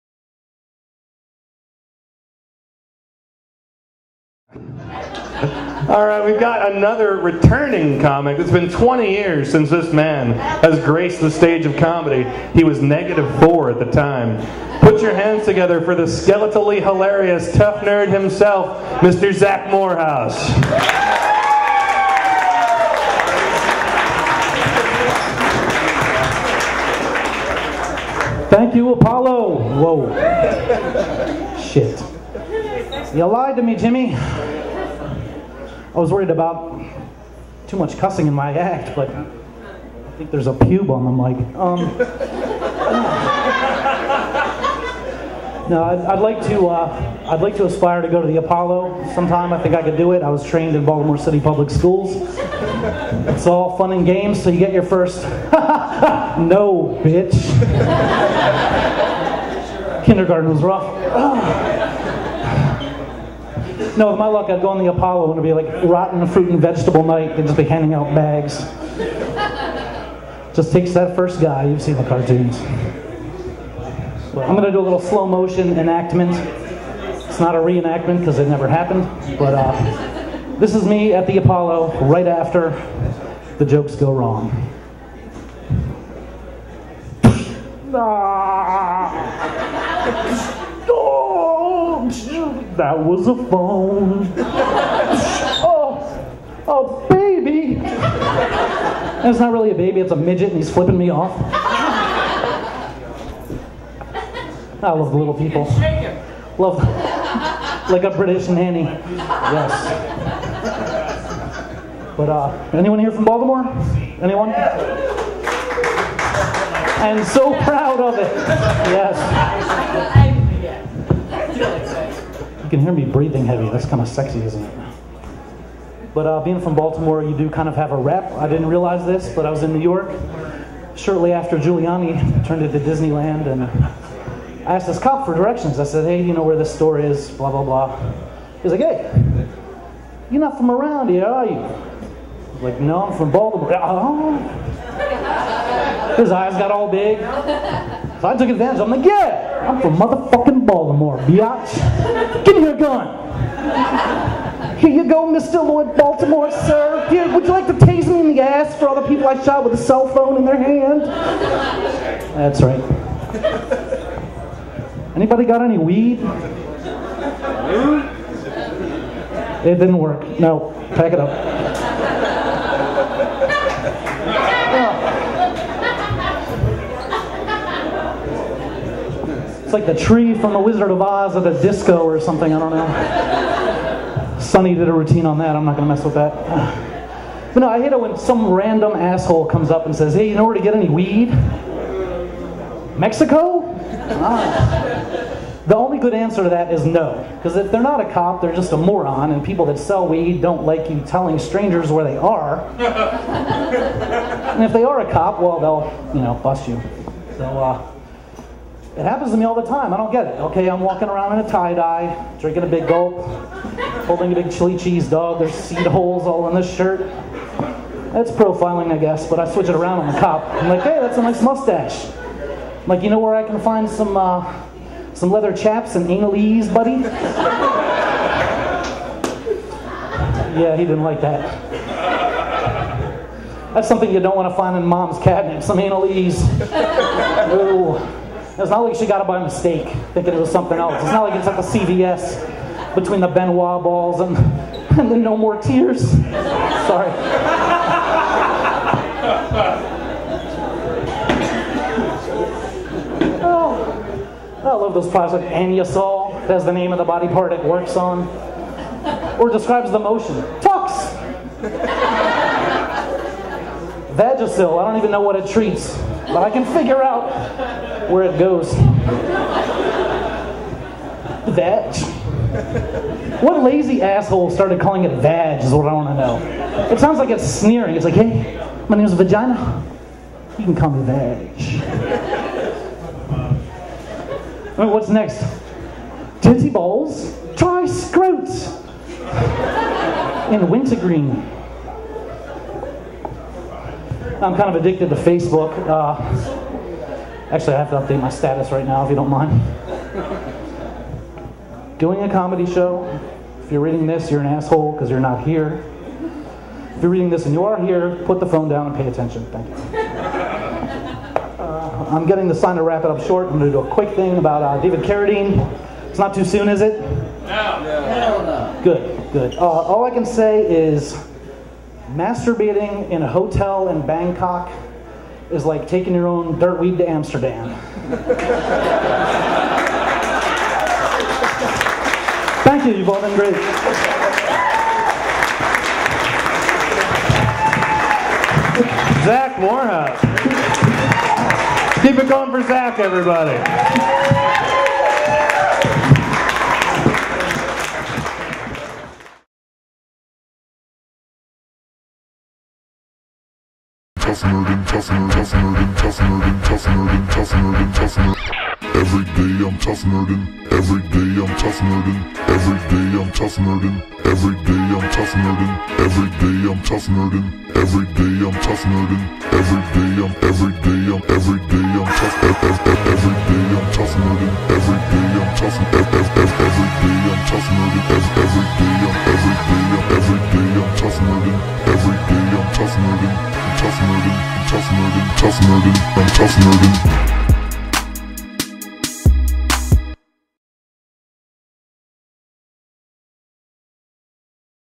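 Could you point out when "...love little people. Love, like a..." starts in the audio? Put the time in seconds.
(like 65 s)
104 s.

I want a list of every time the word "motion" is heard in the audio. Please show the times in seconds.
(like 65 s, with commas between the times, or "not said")
75 s, 259 s.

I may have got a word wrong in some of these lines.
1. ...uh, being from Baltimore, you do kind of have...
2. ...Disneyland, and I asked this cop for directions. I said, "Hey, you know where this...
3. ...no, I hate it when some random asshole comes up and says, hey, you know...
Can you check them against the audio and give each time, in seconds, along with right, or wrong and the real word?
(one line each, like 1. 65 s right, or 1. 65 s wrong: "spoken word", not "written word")
1. 126 s right
2. 132 s right
3. 187 s right.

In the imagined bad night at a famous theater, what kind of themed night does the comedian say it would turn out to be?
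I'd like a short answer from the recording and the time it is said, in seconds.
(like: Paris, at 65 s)
Rotten fruit and vegetable night, at 65 s.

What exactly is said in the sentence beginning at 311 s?
Uh, I'm getting the sign to wrap it up short.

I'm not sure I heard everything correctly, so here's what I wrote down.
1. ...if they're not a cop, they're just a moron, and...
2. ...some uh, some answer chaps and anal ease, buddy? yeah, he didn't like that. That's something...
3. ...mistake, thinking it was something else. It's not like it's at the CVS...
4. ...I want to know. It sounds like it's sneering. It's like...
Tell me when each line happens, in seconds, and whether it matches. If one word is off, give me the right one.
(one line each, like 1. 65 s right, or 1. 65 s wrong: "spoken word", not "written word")
1. 197 s right
2. 223 s wrong: "leather", not "answer"
3. 239 s right
4. 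275 s right.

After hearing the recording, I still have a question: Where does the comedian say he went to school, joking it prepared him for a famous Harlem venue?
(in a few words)
Baltimore City Public Schools.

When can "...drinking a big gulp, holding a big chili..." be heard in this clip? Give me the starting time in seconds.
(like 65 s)
212 s.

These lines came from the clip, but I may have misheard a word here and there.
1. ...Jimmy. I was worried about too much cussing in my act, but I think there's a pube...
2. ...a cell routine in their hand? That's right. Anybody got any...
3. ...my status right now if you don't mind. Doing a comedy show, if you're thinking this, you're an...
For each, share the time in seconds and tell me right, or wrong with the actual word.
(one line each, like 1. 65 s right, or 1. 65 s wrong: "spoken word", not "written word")
1. 33 s right
2. 159 s wrong: "phone", not "routine"
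3. 298 s wrong: "reading", not "thinking".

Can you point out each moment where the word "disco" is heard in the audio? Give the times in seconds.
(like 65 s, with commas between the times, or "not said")
181 s.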